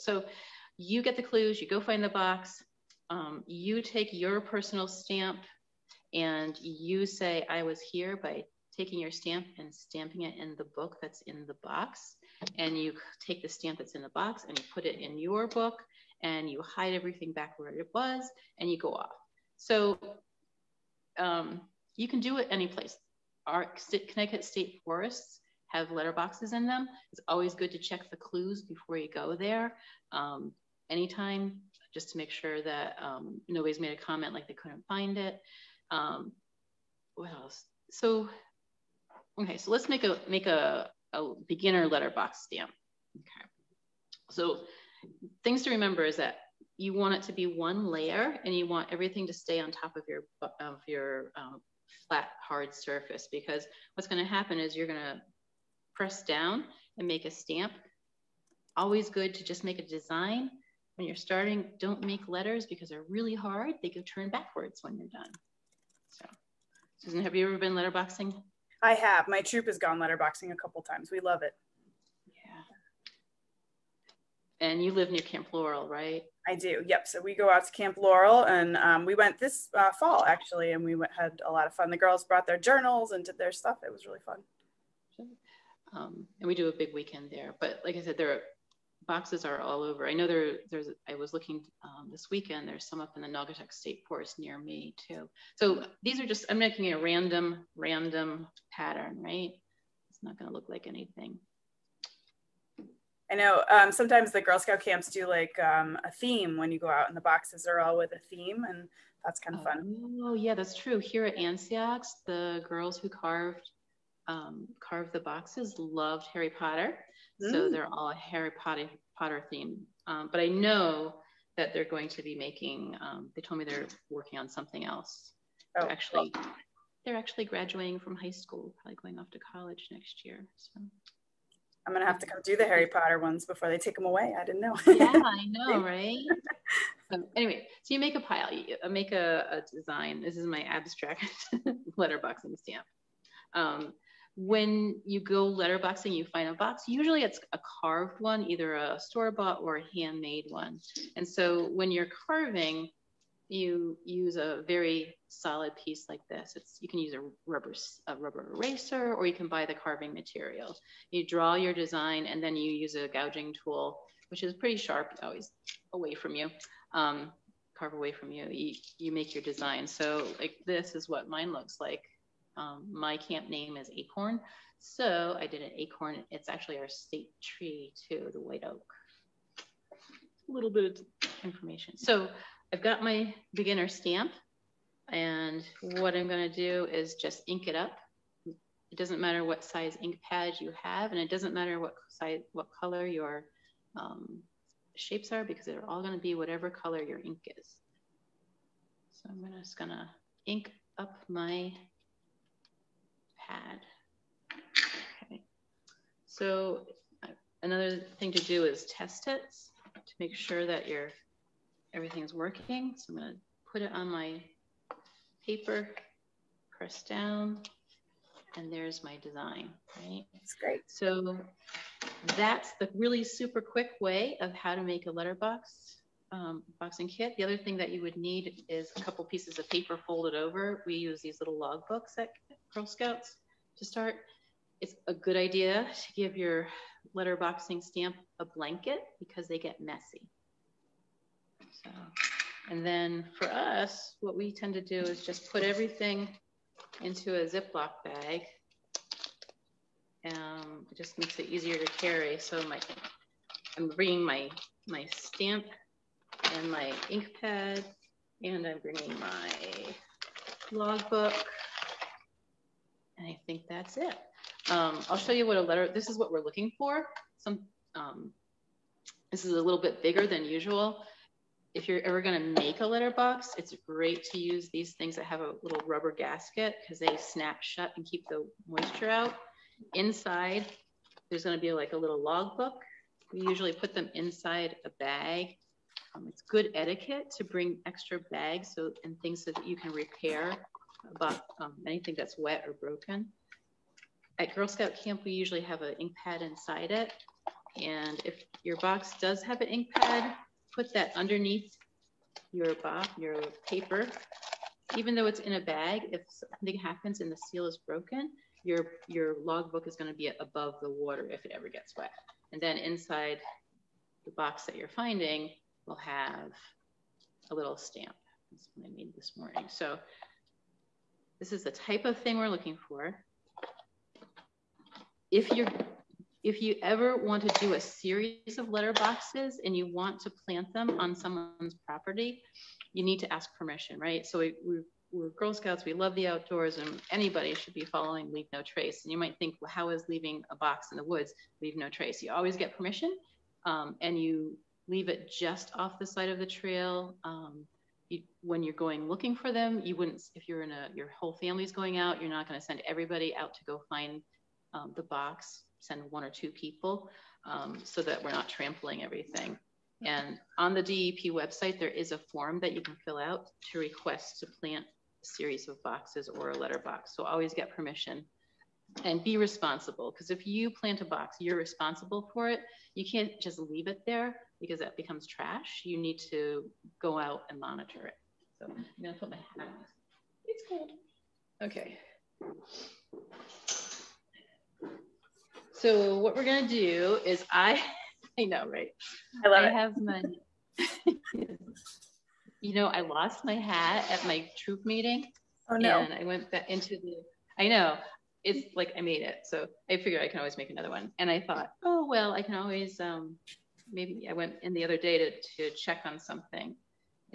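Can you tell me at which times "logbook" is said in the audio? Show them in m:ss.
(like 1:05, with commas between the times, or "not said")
3:51, 4:20, 4:42, 5:09.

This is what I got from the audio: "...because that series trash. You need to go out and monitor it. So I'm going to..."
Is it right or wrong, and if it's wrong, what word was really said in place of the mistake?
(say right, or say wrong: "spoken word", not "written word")
wrong: "becomes", not "series".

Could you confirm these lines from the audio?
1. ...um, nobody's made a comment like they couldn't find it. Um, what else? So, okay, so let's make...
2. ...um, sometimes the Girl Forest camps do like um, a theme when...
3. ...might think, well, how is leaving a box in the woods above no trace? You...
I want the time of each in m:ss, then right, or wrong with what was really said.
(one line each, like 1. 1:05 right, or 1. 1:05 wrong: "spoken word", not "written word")
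1. 0:33 right
2. 1:43 wrong: "Scout", not "Forest"
3. 5:39 wrong: "leave", not "above".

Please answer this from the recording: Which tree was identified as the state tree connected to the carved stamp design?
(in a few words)
White oak.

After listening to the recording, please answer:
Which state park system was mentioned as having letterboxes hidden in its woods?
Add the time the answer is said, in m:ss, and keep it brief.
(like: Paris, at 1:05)
Connecticut State Forests, at 0:24.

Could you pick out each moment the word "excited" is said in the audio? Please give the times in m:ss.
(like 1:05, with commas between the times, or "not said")
not said.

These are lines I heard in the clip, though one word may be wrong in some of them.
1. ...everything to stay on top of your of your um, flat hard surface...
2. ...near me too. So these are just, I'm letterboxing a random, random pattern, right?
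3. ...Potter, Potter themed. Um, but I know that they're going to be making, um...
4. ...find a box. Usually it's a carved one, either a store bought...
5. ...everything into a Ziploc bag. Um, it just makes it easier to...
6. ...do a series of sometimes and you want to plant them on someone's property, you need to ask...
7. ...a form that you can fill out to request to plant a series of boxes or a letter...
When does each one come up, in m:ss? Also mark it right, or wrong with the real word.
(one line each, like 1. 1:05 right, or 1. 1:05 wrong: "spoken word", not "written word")
1. 0:48 right
2. 1:34 wrong: "making", not "letterboxing"
3. 1:58 right
4. 2:26 right
5. 4:05 right
6. 5:27 wrong: "letterboxes", not "sometimes"
7. 6:02 right.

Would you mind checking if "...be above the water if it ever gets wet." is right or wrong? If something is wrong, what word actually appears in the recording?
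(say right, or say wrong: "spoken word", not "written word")
right.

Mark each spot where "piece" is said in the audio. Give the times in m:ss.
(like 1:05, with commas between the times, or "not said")
2:35, 3:49.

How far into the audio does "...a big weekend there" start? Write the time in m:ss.
1:26.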